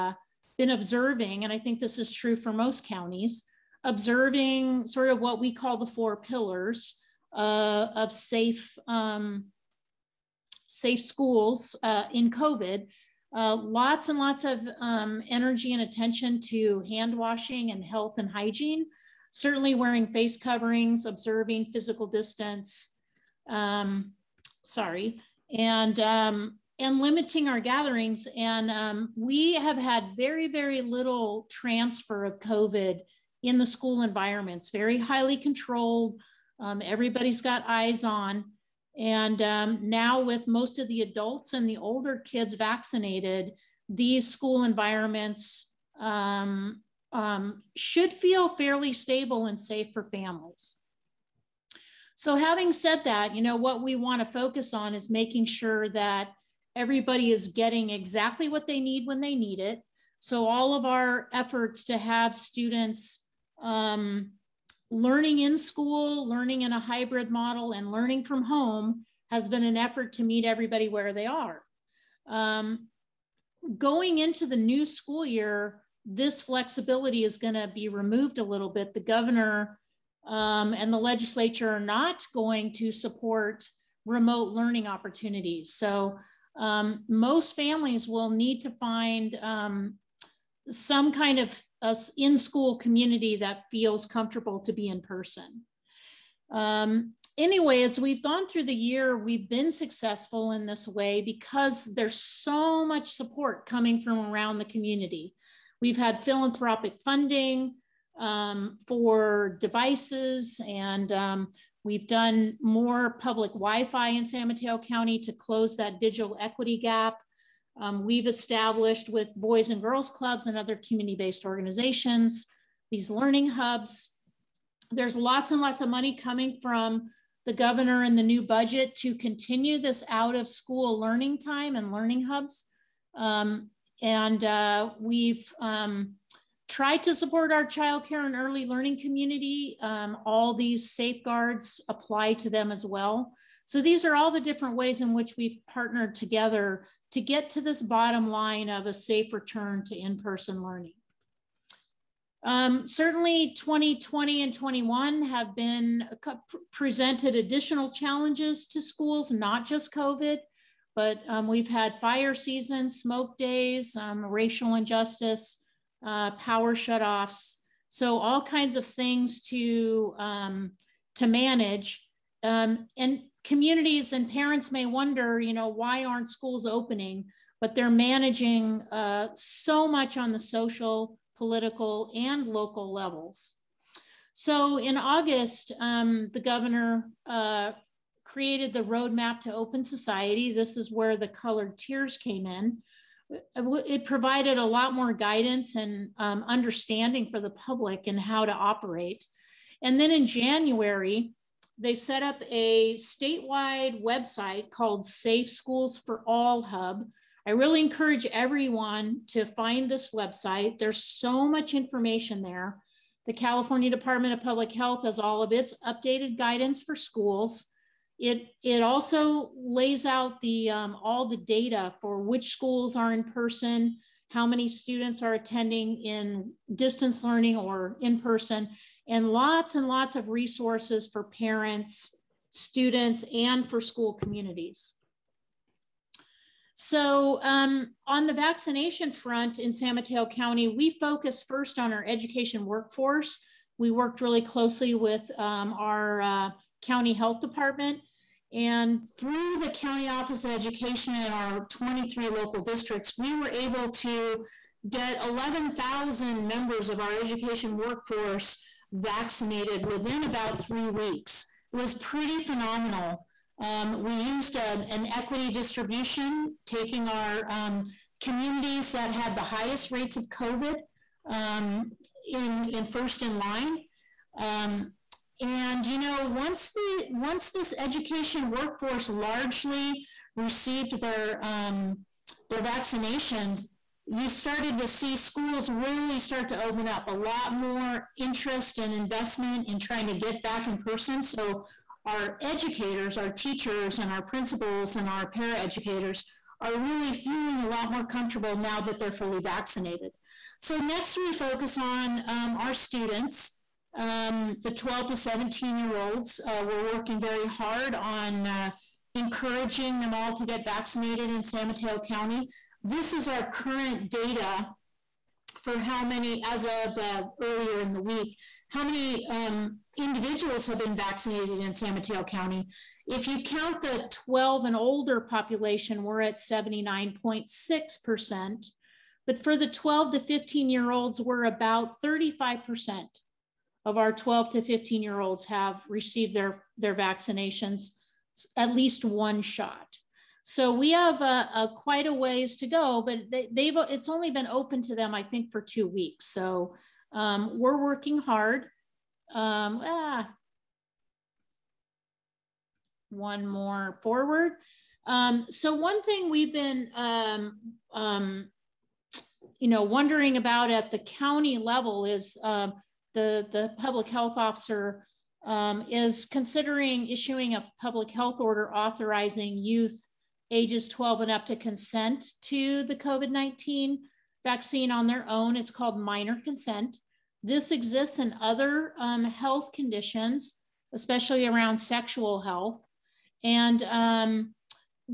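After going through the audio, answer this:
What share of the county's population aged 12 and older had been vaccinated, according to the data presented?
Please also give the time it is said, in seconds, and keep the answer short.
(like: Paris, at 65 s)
79.6%, at 326 s.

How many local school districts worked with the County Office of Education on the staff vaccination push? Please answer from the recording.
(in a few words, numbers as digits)
23.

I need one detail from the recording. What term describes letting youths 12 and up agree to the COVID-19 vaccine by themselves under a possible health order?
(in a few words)
minor consent.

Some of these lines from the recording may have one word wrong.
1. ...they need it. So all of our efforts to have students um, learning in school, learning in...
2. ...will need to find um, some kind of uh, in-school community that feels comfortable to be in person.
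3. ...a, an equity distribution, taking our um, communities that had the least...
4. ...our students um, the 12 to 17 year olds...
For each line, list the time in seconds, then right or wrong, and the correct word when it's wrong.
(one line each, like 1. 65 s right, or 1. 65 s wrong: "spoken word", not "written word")
1. 59 s right
2. 88 s right
3. 264 s wrong: "highest", not "least"
4. 302 s right.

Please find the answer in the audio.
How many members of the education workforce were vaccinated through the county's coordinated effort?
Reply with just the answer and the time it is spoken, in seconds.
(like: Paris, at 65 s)
11,000, at 255 s.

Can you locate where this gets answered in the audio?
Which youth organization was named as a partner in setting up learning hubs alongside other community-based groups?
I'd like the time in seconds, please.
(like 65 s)
119 s.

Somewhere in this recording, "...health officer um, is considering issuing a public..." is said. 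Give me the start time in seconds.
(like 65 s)
364 s.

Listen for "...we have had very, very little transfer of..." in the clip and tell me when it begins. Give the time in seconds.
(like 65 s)
29 s.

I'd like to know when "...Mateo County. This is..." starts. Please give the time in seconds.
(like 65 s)
311 s.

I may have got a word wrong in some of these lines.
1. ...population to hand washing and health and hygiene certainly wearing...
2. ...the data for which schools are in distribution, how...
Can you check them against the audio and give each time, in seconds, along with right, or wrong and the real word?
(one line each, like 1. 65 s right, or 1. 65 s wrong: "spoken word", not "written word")
1. 15 s wrong: "attention", not "population"
2. 221 s wrong: "person", not "distribution".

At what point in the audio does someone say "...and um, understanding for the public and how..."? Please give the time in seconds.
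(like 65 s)
195 s.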